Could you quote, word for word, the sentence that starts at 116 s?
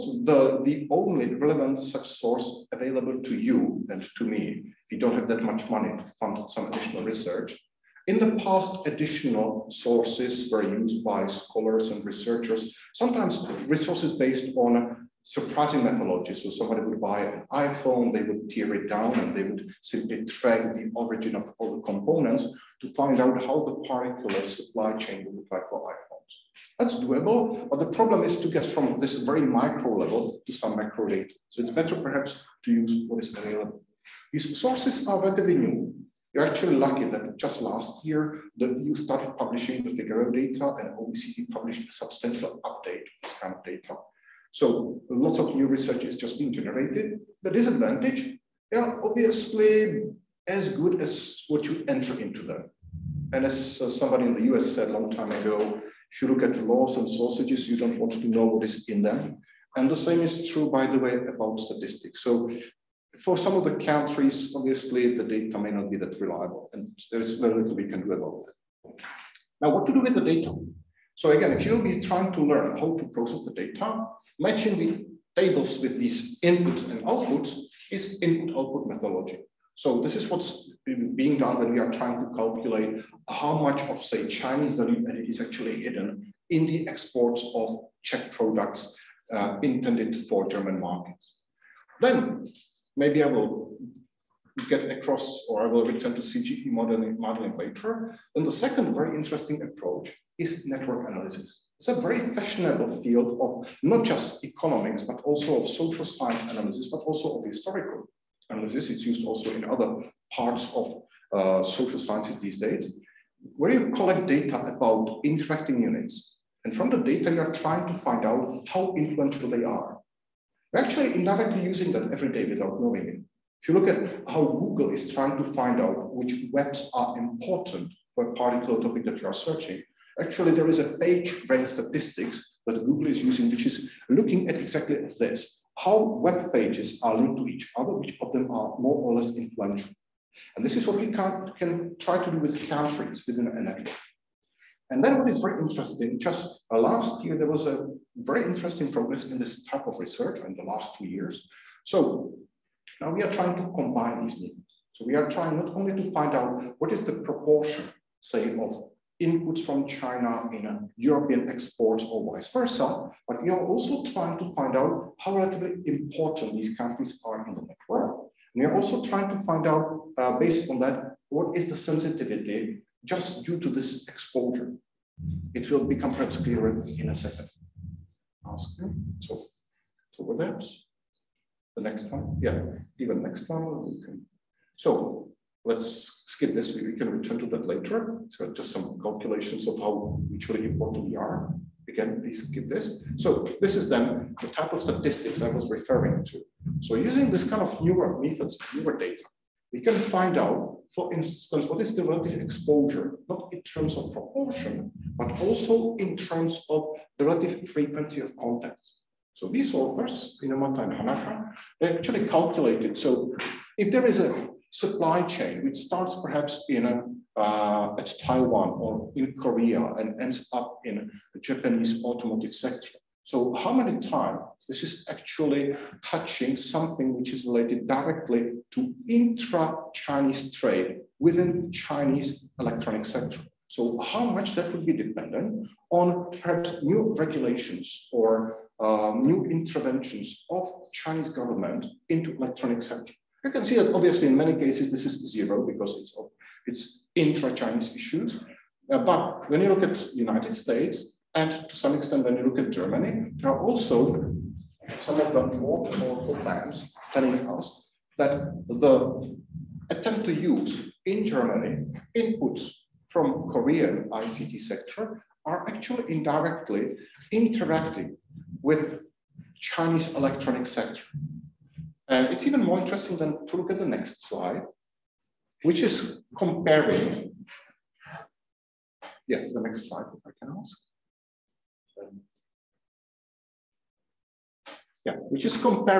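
And from the data, you're trying to find out how influential they are.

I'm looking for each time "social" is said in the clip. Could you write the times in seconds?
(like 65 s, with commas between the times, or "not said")
105 s, 111 s.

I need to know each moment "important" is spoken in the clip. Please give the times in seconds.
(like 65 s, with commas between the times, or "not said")
127 s, 165 s, 190 s.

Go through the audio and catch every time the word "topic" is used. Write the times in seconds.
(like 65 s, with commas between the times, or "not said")
128 s.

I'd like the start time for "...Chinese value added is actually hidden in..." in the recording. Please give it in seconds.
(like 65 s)
84 s.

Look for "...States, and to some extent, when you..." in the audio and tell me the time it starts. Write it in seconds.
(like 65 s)
250 s.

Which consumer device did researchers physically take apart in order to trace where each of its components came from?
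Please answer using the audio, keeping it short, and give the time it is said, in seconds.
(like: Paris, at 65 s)
iPhone, at 17 s.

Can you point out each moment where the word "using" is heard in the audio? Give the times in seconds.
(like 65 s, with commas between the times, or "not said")
121 s, 133 s, 196 s.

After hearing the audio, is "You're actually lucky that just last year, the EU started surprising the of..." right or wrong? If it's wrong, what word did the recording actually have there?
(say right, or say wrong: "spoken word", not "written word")
wrong: "publishing", not "surprising".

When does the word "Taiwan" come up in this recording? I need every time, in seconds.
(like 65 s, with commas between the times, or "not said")
218 s.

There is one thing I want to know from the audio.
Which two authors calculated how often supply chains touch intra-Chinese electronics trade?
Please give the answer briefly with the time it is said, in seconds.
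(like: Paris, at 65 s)
Inomata and Hanaka, at 210 s.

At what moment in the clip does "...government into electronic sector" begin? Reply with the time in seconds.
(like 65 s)
241 s.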